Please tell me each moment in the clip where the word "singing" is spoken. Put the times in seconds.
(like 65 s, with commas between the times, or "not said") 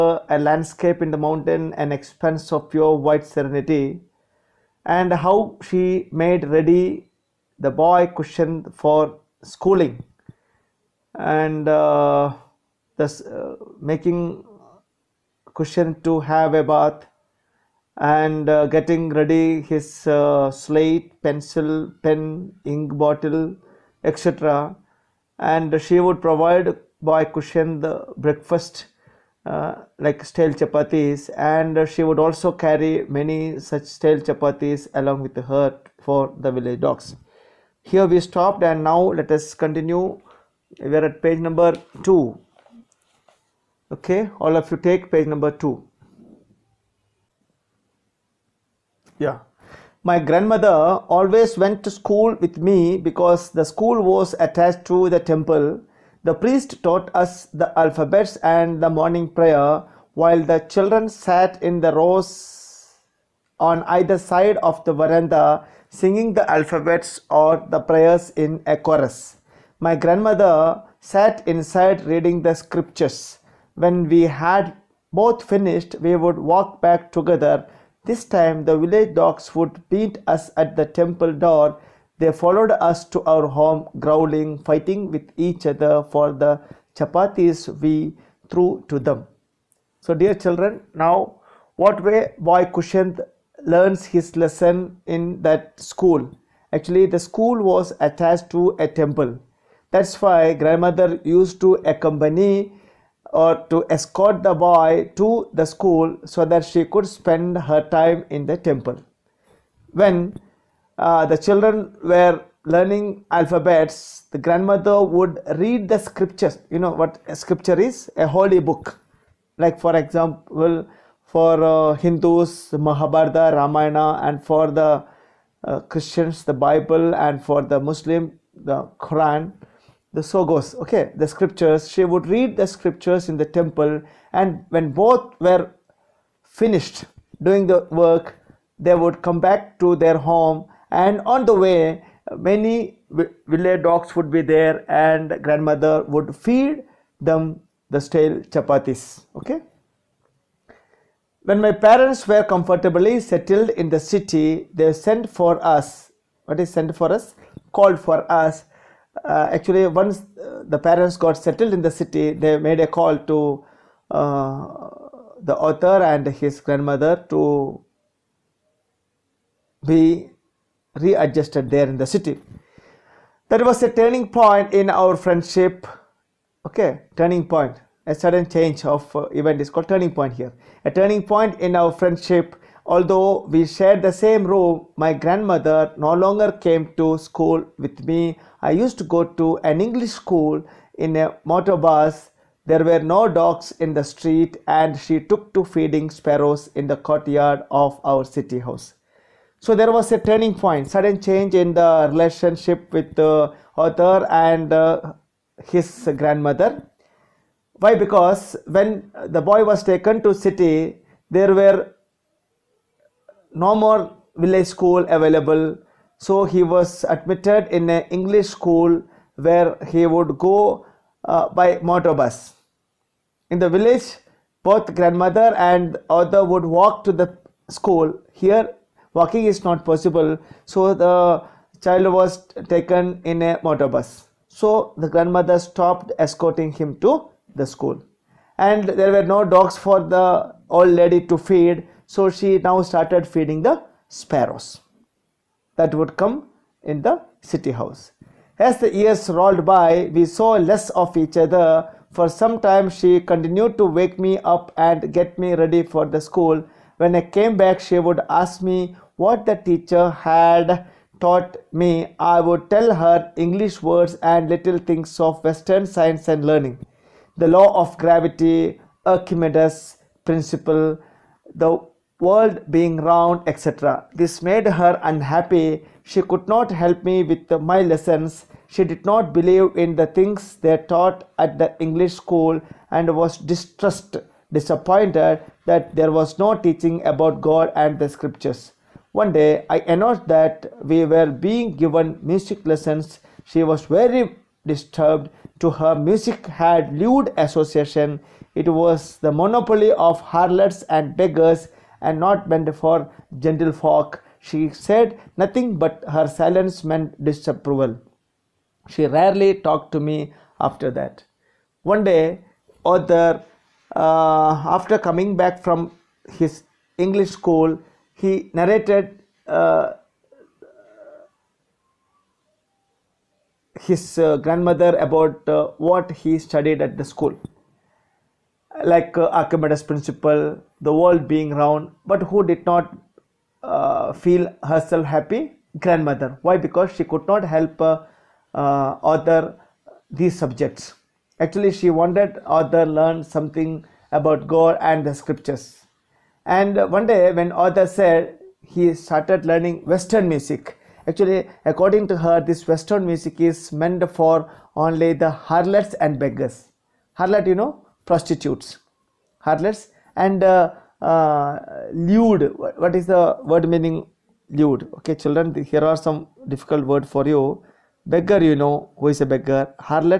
65 s.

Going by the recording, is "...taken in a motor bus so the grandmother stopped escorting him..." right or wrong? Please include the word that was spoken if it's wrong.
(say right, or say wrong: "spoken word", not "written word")
right.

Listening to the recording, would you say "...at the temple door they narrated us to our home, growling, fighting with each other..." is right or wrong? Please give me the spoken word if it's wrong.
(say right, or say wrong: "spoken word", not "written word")
wrong: "followed", not "narrated".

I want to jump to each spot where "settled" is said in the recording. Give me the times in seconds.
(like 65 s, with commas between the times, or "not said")
153 s, 161 s.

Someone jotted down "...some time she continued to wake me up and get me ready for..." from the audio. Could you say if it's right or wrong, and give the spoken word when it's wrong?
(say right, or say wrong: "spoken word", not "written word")
right.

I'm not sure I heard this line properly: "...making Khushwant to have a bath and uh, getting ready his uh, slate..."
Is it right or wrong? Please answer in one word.
right.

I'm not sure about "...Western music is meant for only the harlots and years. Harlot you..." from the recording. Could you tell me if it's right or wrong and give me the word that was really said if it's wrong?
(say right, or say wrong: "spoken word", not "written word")
wrong: "beggars", not "years".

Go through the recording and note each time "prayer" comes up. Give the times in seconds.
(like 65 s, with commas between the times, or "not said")
59 s, 67 s.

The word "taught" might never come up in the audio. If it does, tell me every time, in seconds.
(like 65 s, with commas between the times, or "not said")
56 s, 261 s, 280 s.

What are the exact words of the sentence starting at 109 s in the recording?
When uh, the children were learning alphabets, the grandmother would read the scriptures.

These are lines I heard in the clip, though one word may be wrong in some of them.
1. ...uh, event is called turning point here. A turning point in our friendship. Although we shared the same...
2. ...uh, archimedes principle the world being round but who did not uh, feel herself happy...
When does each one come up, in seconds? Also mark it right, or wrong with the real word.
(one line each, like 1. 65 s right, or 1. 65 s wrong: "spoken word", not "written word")
1. 179 s right
2. 329 s right.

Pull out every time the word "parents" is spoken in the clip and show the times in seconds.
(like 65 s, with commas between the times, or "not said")
151 s, 160 s.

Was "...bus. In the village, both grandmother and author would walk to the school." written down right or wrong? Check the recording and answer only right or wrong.
right.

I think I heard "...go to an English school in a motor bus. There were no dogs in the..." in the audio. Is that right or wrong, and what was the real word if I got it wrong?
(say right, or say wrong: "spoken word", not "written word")
right.